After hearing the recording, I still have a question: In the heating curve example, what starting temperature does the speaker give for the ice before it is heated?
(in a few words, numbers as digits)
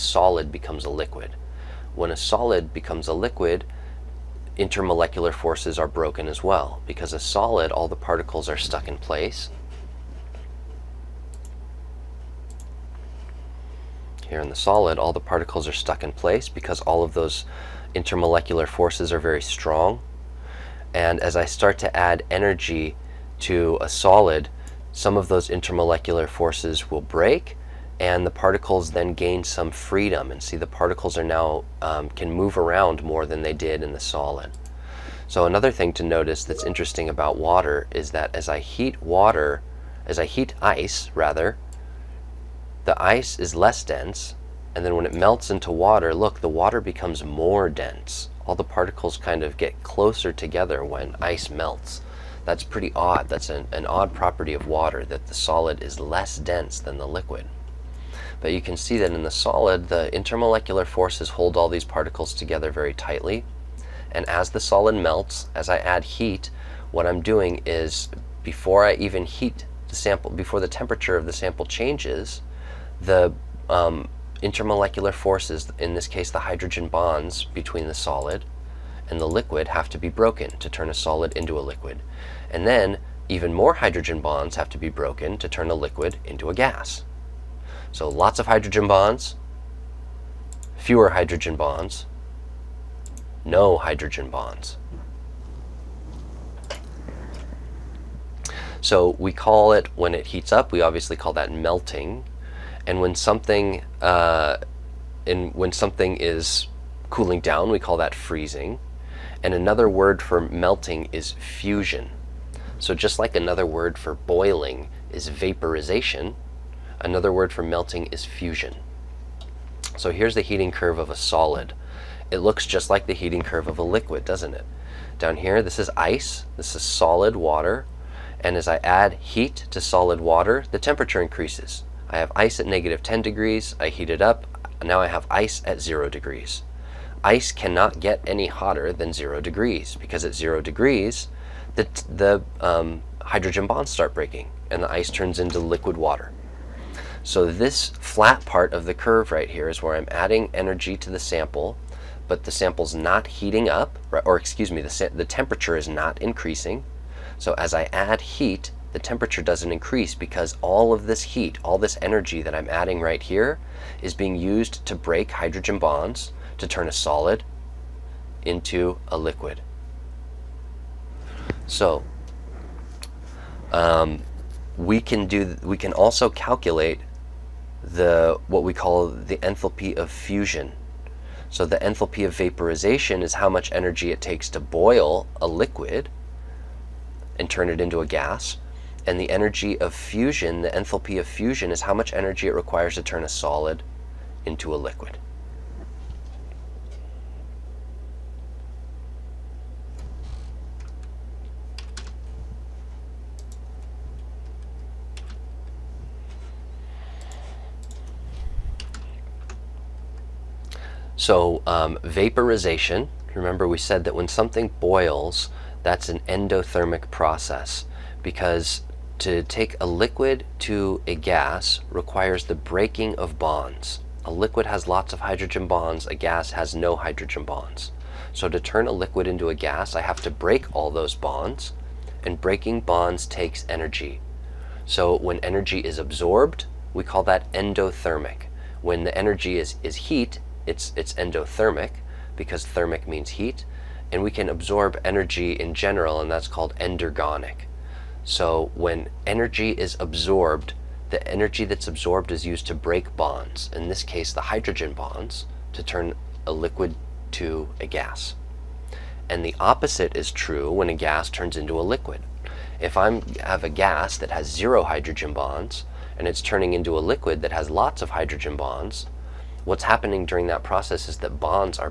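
-10 degrees.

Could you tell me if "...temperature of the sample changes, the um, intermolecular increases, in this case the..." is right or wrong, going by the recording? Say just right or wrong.
wrong.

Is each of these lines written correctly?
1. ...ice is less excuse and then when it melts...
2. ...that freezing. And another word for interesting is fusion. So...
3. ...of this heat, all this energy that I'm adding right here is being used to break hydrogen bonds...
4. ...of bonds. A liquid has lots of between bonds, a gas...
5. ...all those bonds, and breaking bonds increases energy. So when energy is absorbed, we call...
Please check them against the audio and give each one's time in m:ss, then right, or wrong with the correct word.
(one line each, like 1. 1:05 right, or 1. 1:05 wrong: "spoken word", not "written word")
1. 0:43 wrong: "dense", not "excuse"
2. 1:47 wrong: "melting", not "interesting"
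3. 2:40 right
4. 3:43 wrong: "hydrogen", not "between"
5. 3:50 wrong: "takes", not "increases".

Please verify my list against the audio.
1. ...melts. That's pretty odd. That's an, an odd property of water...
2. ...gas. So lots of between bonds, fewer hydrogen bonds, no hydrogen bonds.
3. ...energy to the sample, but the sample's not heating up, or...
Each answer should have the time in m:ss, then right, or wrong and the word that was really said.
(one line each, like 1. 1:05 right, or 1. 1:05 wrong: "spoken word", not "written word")
1. 0:51 right
2. 1:26 wrong: "hydrogen", not "between"
3. 2:30 right.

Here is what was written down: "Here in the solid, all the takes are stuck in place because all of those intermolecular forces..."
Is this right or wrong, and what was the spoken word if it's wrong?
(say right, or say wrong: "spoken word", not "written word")
wrong: "particles", not "takes".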